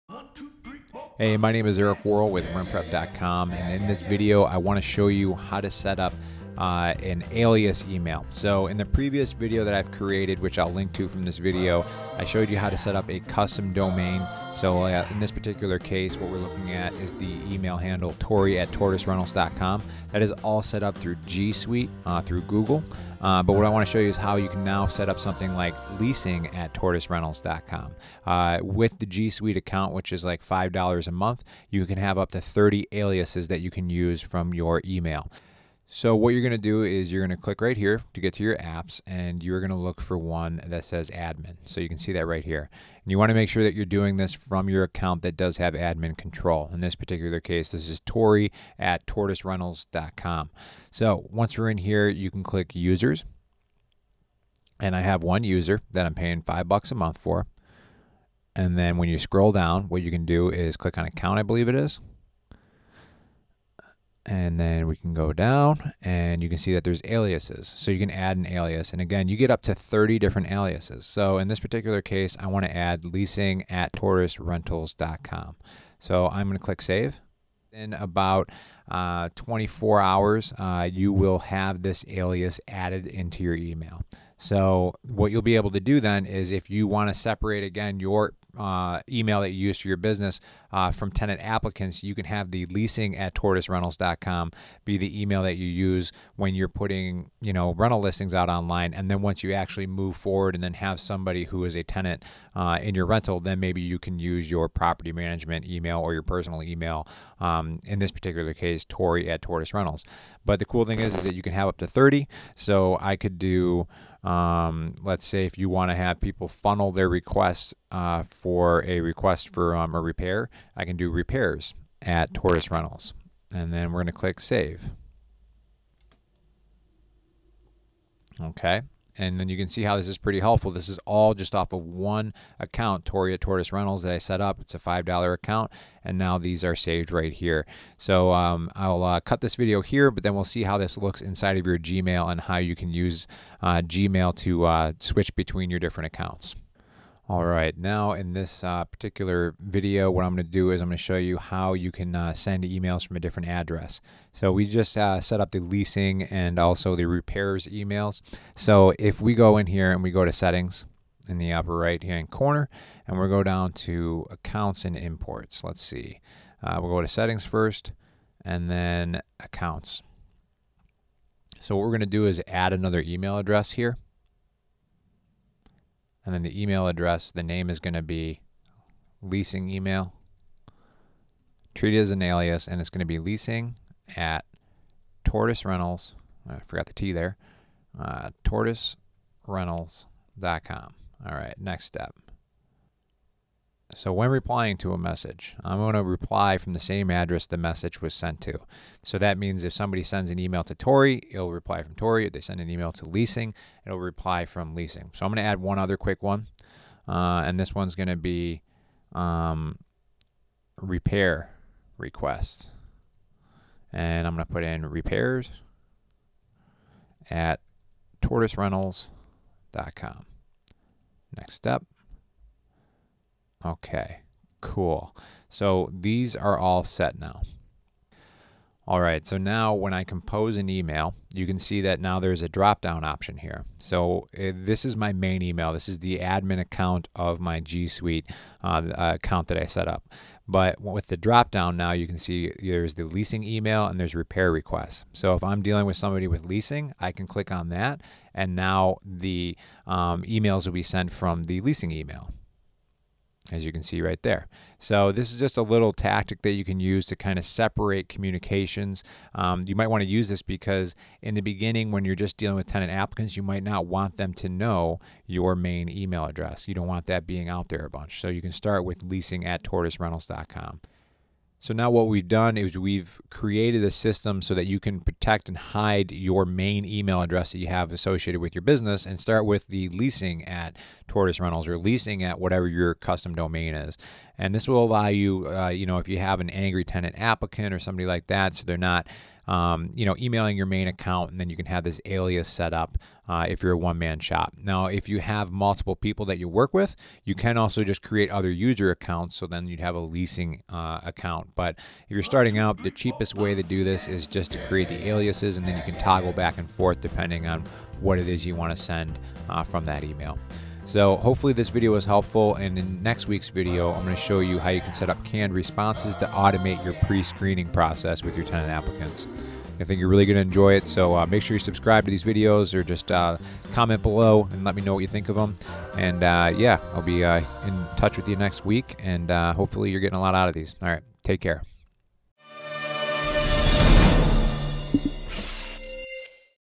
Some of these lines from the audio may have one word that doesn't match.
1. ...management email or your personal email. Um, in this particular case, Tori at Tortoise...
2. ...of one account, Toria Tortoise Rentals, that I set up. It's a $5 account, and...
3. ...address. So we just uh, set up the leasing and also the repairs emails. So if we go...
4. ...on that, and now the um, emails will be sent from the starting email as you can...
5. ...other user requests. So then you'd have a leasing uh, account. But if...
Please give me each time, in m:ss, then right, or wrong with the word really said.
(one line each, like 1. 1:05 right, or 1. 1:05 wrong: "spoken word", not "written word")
1. 1:45 right
2. 2:11 right
3. 2:33 right
4. 4:07 wrong: "leasing", not "starting"
5. 4:58 wrong: "accounts", not "requests".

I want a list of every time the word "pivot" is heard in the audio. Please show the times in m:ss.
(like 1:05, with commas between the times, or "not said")
not said.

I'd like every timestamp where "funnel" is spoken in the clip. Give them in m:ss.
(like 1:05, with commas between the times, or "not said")
1:56.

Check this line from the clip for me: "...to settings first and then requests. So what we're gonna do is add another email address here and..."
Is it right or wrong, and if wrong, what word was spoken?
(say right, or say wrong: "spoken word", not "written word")
wrong: "accounts", not "requests".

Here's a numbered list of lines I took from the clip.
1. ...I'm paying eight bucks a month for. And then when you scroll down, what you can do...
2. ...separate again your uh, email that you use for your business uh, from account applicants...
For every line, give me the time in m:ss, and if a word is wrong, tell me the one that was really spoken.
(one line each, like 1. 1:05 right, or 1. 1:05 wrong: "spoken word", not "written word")
1. 0:56 wrong: "five", not "eight"
2. 1:27 wrong: "tenant", not "account".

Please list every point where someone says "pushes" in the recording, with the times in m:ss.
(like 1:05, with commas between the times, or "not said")
not said.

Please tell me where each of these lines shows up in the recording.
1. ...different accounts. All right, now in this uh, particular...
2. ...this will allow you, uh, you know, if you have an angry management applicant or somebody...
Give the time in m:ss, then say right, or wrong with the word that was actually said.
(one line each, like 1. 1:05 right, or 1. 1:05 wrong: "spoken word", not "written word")
1. 2:25 right
2. 4:44 wrong: "tenant", not "management".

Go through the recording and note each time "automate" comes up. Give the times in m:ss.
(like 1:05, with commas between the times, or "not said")
5:16.